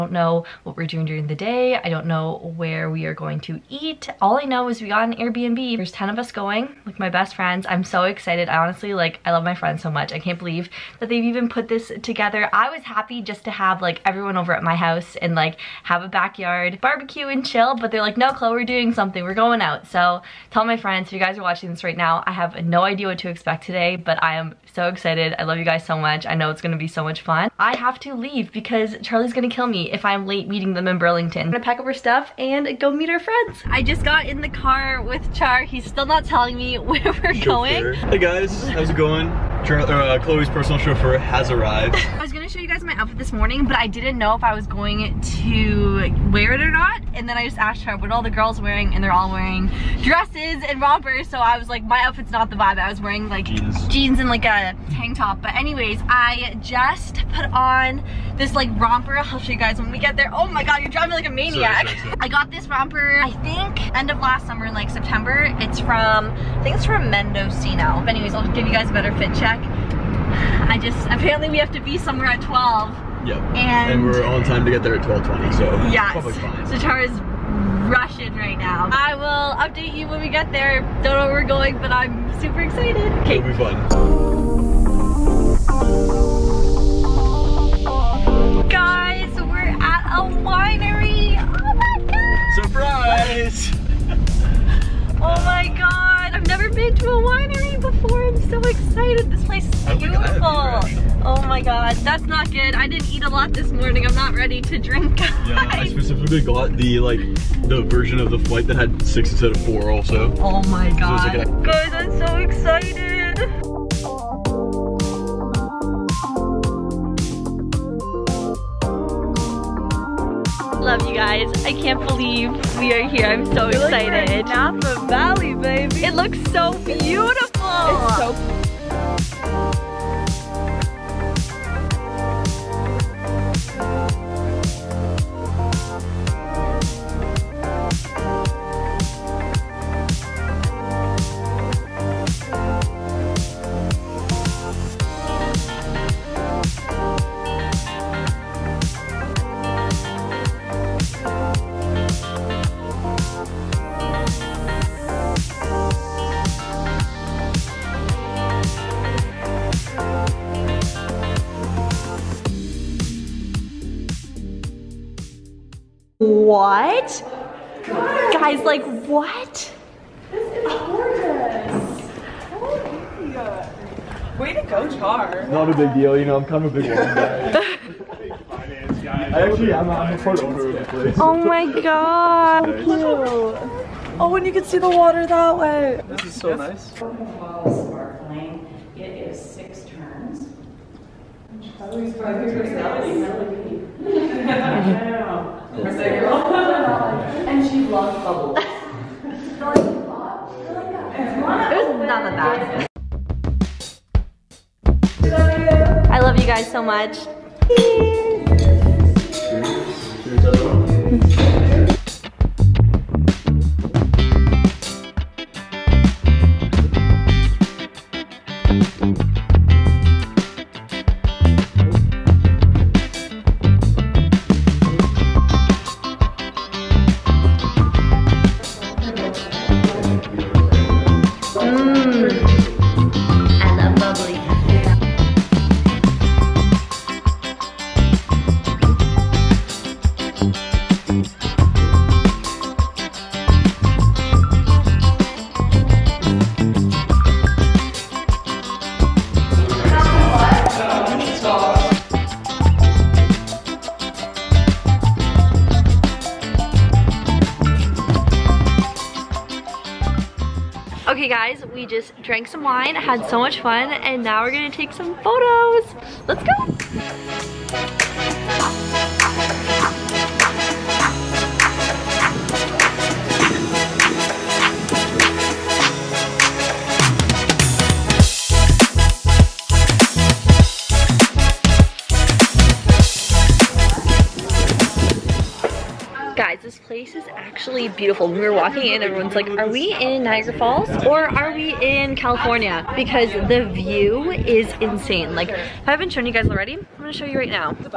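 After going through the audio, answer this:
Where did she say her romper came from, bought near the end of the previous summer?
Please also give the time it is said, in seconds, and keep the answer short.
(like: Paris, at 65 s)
Mendocino, at 67 s.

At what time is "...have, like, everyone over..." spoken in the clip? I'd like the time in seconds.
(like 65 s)
13 s.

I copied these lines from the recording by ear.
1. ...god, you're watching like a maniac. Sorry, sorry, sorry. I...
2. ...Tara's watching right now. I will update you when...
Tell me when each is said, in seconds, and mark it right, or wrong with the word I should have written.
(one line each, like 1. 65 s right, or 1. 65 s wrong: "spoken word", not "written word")
1. 60 s wrong: "driving", not "watching"
2. 76 s wrong: "rushing", not "watching".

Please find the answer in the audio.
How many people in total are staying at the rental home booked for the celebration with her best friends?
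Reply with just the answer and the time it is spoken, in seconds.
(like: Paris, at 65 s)
10, at 5 s.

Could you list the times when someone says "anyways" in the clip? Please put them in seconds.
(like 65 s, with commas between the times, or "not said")
55 s, 68 s.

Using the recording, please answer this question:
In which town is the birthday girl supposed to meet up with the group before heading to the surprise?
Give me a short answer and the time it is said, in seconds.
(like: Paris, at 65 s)
Burlington, at 30 s.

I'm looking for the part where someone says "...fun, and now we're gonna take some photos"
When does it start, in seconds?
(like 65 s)
263 s.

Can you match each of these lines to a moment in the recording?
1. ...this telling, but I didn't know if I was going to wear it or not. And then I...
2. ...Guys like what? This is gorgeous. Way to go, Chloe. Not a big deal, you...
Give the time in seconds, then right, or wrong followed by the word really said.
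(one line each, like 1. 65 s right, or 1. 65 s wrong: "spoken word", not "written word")
1. 43 s wrong: "morning", not "telling"
2. 168 s wrong: "Char", not "Chloe".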